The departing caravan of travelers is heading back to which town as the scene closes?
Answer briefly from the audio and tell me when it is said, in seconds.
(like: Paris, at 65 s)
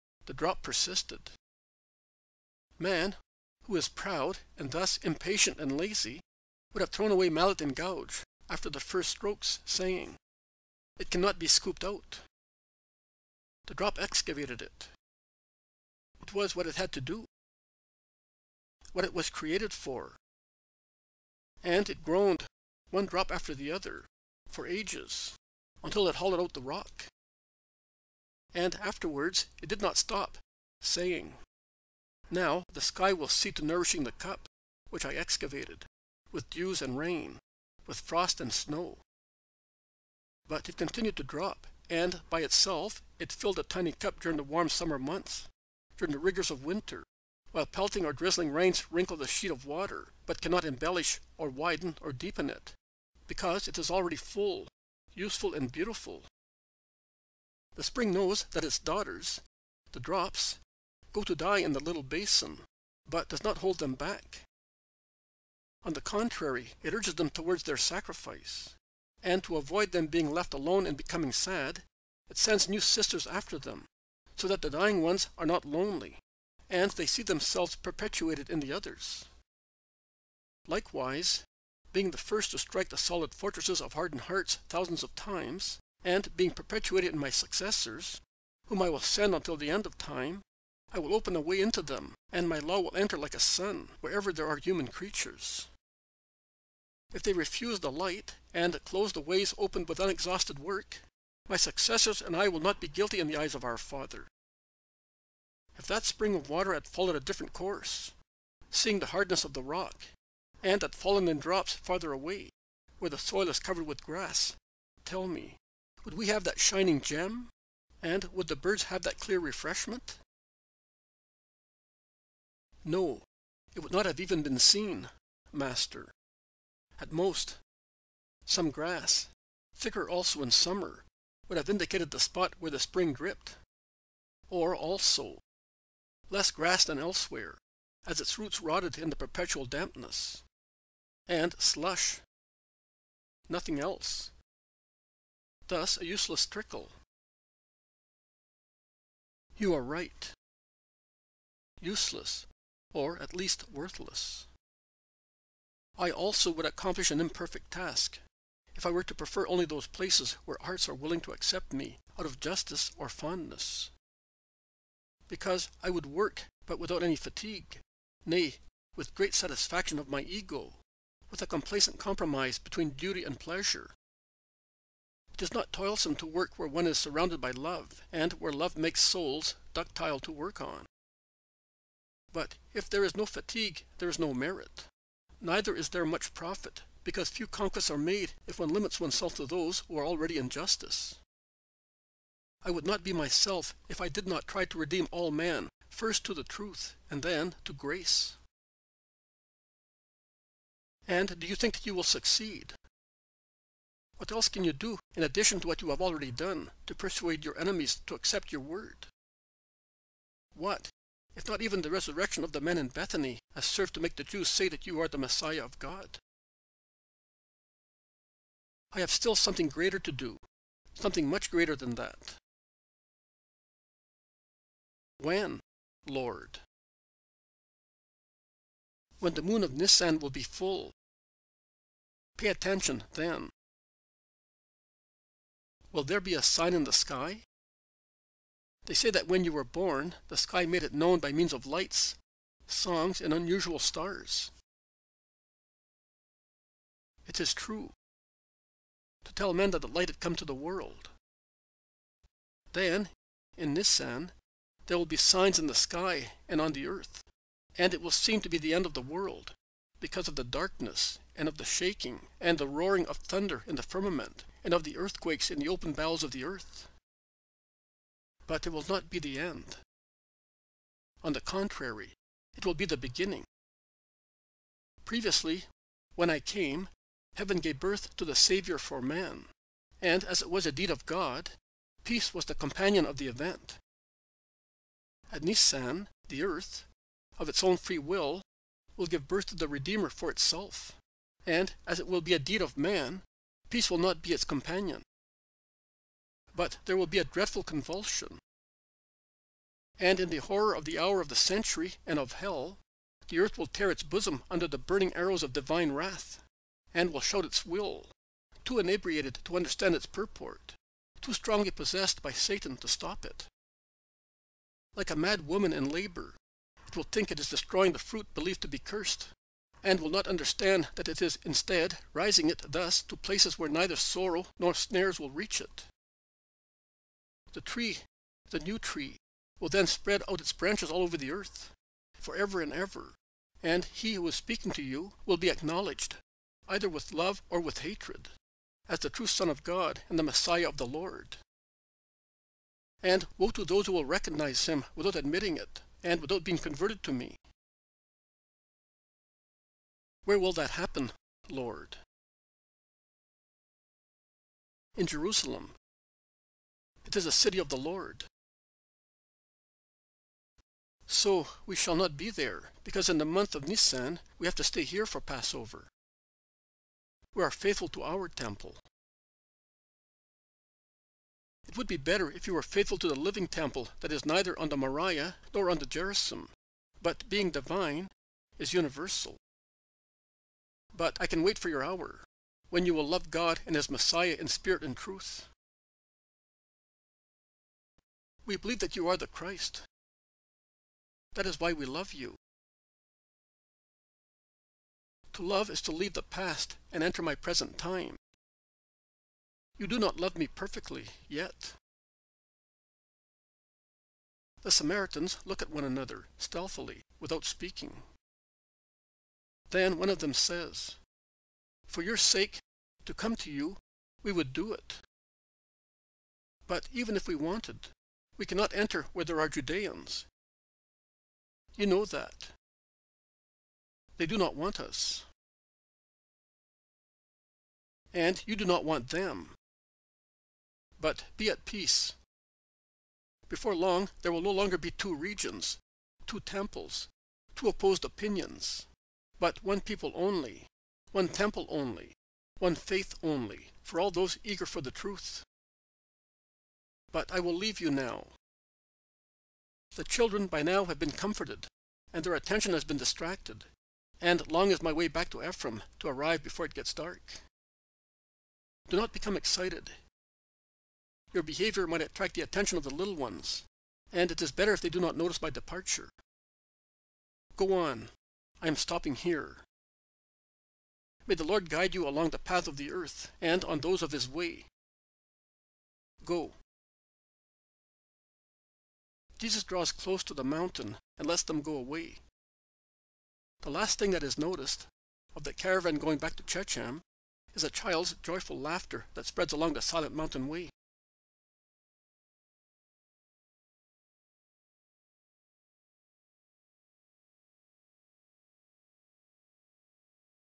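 Shechem, at 486 s.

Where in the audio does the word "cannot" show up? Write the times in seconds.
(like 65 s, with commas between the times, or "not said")
11 s, 50 s, 418 s.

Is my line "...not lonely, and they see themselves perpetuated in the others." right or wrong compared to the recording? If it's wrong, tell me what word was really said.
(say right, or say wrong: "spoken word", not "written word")
right.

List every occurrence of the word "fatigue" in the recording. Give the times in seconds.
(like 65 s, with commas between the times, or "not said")
167 s, 183 s.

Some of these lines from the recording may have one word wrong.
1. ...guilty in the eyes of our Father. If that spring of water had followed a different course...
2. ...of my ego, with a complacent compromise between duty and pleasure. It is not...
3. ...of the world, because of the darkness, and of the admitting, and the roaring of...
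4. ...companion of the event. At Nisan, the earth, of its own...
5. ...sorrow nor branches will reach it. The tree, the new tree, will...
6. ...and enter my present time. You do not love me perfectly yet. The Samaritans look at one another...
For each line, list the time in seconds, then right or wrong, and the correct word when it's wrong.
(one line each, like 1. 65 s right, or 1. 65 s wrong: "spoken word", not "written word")
1. 102 s right
2. 169 s right
3. 258 s wrong: "shaking", not "admitting"
4. 282 s right
5. 323 s wrong: "snares", not "branches"
6. 396 s right.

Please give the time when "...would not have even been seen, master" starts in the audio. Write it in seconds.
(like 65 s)
123 s.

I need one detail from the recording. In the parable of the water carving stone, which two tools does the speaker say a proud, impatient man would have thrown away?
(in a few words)
mallet and gouge.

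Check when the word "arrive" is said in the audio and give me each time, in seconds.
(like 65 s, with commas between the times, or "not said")
456 s.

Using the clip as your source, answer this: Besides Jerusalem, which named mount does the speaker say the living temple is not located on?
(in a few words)
Moriah.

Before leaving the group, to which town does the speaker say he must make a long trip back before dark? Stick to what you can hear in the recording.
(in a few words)
Ephraim.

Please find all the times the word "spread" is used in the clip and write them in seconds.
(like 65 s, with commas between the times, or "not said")
329 s, 489 s.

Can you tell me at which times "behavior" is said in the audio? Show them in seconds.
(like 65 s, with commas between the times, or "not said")
461 s.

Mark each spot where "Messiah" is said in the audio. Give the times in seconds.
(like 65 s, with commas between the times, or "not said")
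215 s, 340 s, 383 s.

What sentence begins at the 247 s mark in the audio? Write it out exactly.
It is true to tell men that the light had come to the world.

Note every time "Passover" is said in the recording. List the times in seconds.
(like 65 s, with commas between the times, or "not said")
365 s.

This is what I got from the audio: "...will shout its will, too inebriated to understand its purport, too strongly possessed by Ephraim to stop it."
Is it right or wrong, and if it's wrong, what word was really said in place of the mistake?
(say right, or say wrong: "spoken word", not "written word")
wrong: "Satan", not "Ephraim".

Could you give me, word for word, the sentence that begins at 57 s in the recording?
The spring knows that its daughters, the drops, go to die in the little basin, but does not hold them back.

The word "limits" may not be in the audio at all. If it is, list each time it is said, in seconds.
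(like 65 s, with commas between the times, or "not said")
188 s.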